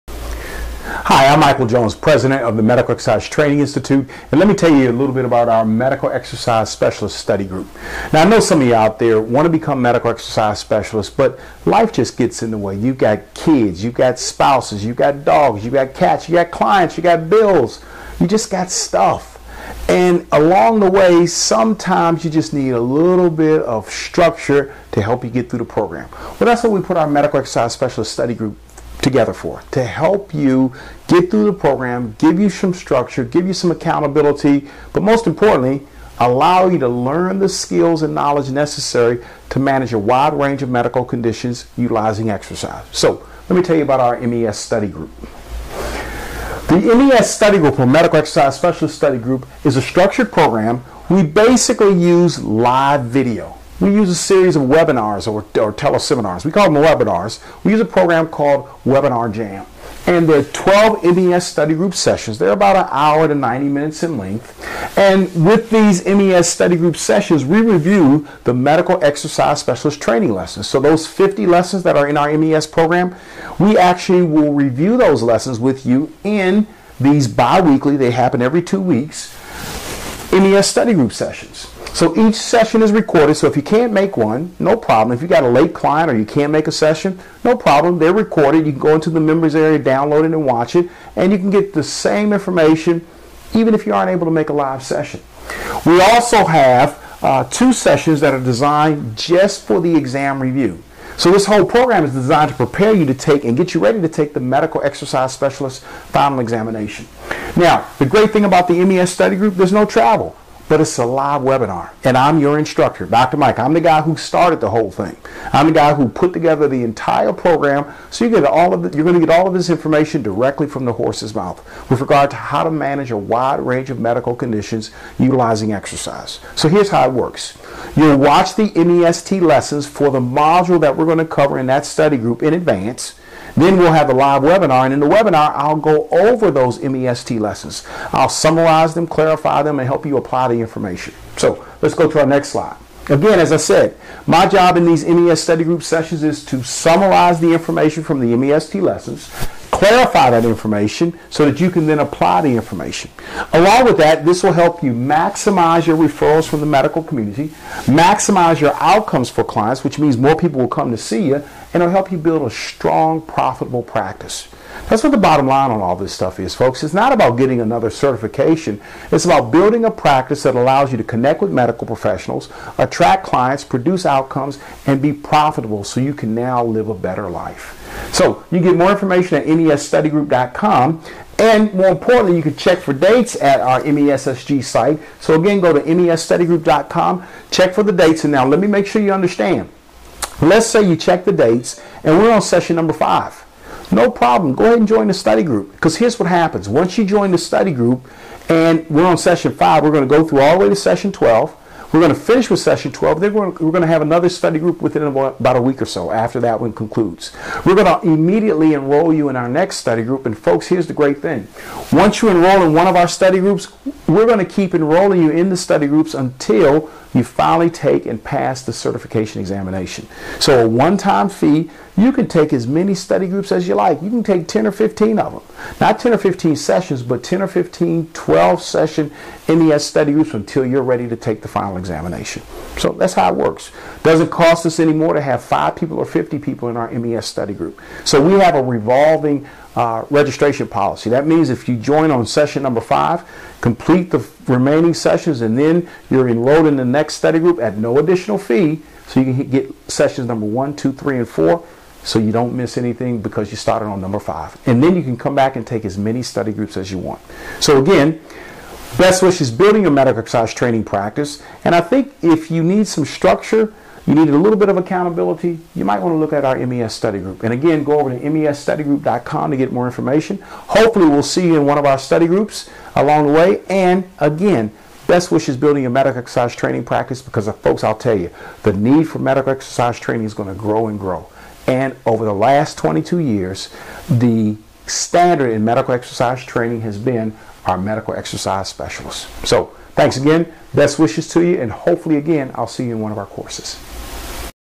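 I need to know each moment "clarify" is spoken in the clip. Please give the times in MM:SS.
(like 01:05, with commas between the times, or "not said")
02:19, 02:29.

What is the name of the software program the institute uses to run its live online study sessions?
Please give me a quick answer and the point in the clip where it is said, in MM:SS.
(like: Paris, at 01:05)
Webinar Jam, at 00:58.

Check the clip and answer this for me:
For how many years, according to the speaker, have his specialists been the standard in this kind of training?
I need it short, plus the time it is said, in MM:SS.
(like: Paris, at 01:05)
22, at 04:42.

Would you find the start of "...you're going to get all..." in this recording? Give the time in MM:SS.
01:58.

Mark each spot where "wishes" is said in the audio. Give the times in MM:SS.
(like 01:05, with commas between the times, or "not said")
04:19, 04:35, 04:50.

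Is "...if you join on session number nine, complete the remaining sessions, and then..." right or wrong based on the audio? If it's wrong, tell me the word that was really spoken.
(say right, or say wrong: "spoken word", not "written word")
wrong: "five", not "nine".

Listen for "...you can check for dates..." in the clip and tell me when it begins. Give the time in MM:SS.
03:02.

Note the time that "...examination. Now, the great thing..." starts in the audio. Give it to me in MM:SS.
01:46.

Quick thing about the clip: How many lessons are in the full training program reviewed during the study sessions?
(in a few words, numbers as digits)
50.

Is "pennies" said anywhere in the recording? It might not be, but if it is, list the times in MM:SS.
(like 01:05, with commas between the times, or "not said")
not said.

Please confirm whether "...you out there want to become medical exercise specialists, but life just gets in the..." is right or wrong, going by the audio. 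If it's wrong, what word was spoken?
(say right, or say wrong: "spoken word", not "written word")
right.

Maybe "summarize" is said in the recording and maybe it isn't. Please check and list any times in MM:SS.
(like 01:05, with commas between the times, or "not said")
02:18, 02:26.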